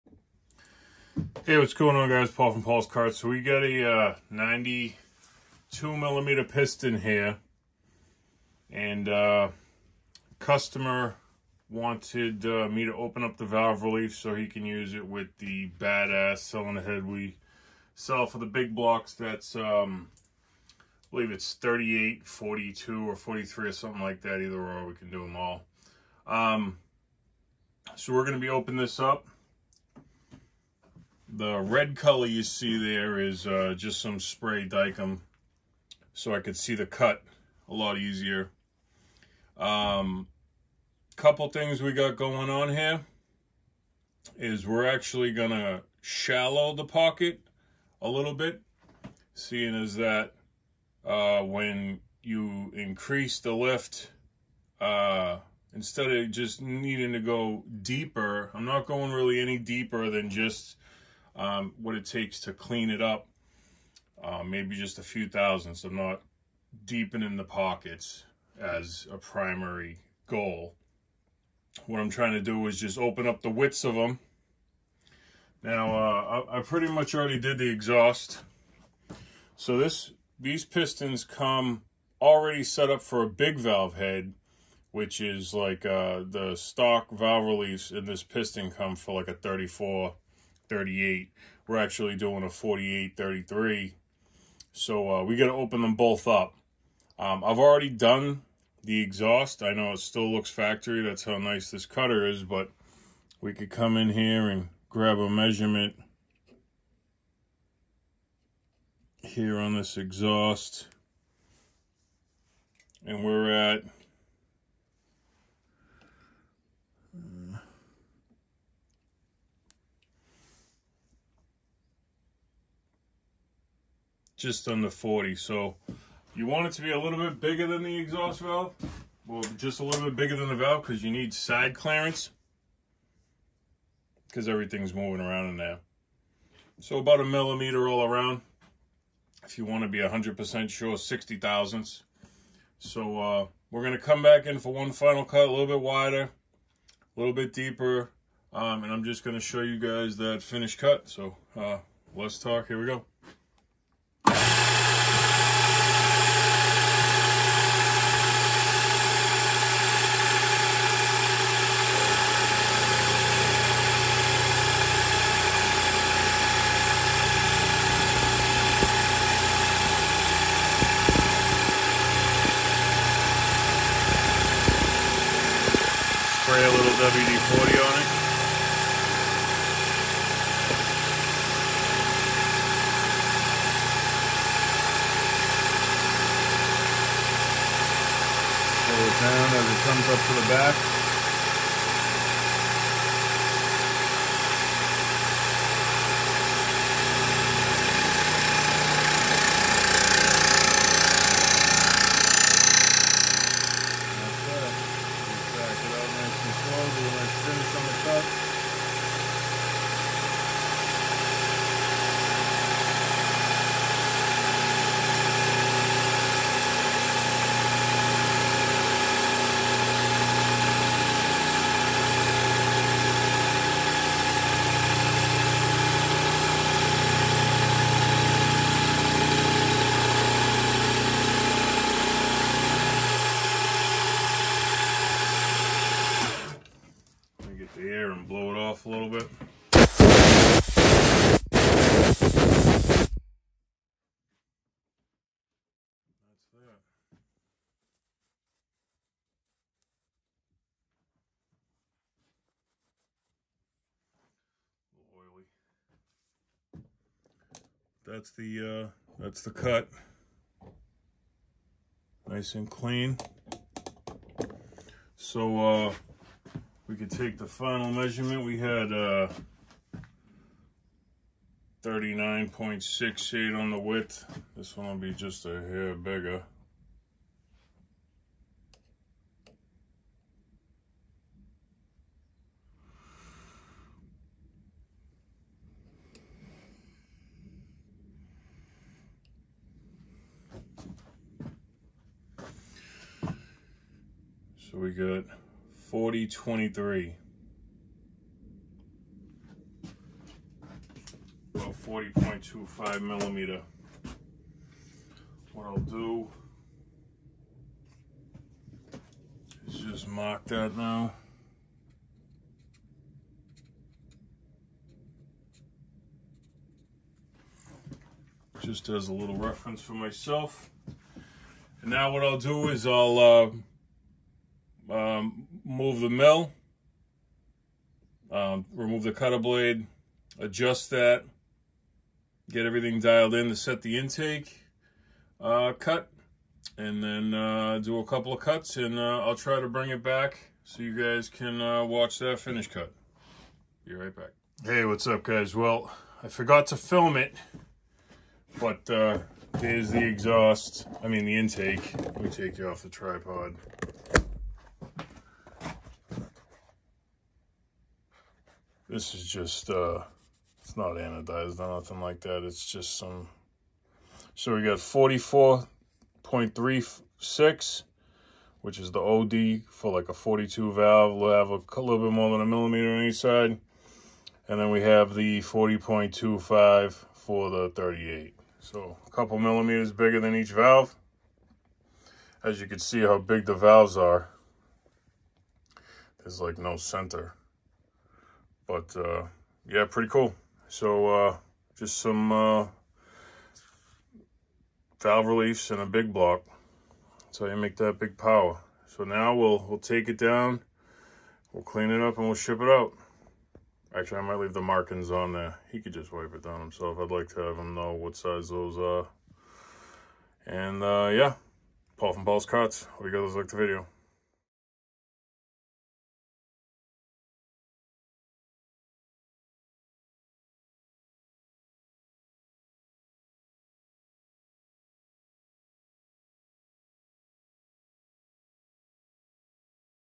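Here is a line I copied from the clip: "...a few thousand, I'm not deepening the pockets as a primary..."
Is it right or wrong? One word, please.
right.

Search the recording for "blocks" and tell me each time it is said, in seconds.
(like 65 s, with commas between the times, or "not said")
18 s, 396 s.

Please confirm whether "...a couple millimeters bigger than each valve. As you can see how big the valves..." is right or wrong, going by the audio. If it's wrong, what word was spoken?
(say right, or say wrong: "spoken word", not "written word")
right.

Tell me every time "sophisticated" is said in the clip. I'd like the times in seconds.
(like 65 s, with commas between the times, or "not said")
not said.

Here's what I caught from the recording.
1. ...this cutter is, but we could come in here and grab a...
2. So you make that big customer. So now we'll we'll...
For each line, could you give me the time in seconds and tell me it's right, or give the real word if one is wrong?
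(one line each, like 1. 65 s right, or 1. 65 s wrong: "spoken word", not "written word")
1. 101 s right
2. 397 s wrong: "power", not "customer".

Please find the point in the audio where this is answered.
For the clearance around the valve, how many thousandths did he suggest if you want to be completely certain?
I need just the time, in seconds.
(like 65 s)
140 s.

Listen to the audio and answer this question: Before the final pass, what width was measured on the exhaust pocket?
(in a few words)
39.68.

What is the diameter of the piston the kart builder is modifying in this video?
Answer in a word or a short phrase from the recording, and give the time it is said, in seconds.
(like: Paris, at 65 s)
92 millimeter, at 4 s.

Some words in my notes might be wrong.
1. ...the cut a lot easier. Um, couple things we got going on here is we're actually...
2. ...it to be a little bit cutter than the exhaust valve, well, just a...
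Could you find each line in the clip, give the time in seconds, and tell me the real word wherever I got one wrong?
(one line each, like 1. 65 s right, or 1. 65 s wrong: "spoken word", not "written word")
1. 36 s right
2. 126 s wrong: "bigger", not "cutter".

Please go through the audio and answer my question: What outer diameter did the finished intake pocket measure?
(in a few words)
44.36.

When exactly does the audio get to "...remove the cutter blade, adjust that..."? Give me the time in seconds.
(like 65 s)
328 s.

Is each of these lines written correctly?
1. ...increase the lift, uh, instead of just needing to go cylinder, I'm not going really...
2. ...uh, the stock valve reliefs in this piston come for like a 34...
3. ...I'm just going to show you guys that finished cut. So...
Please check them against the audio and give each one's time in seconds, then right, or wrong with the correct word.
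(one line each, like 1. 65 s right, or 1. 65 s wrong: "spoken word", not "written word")
1. 52 s wrong: "deeper", not "cylinder"
2. 85 s right
3. 148 s right.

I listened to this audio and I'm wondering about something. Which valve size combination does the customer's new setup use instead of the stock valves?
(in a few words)
48 33.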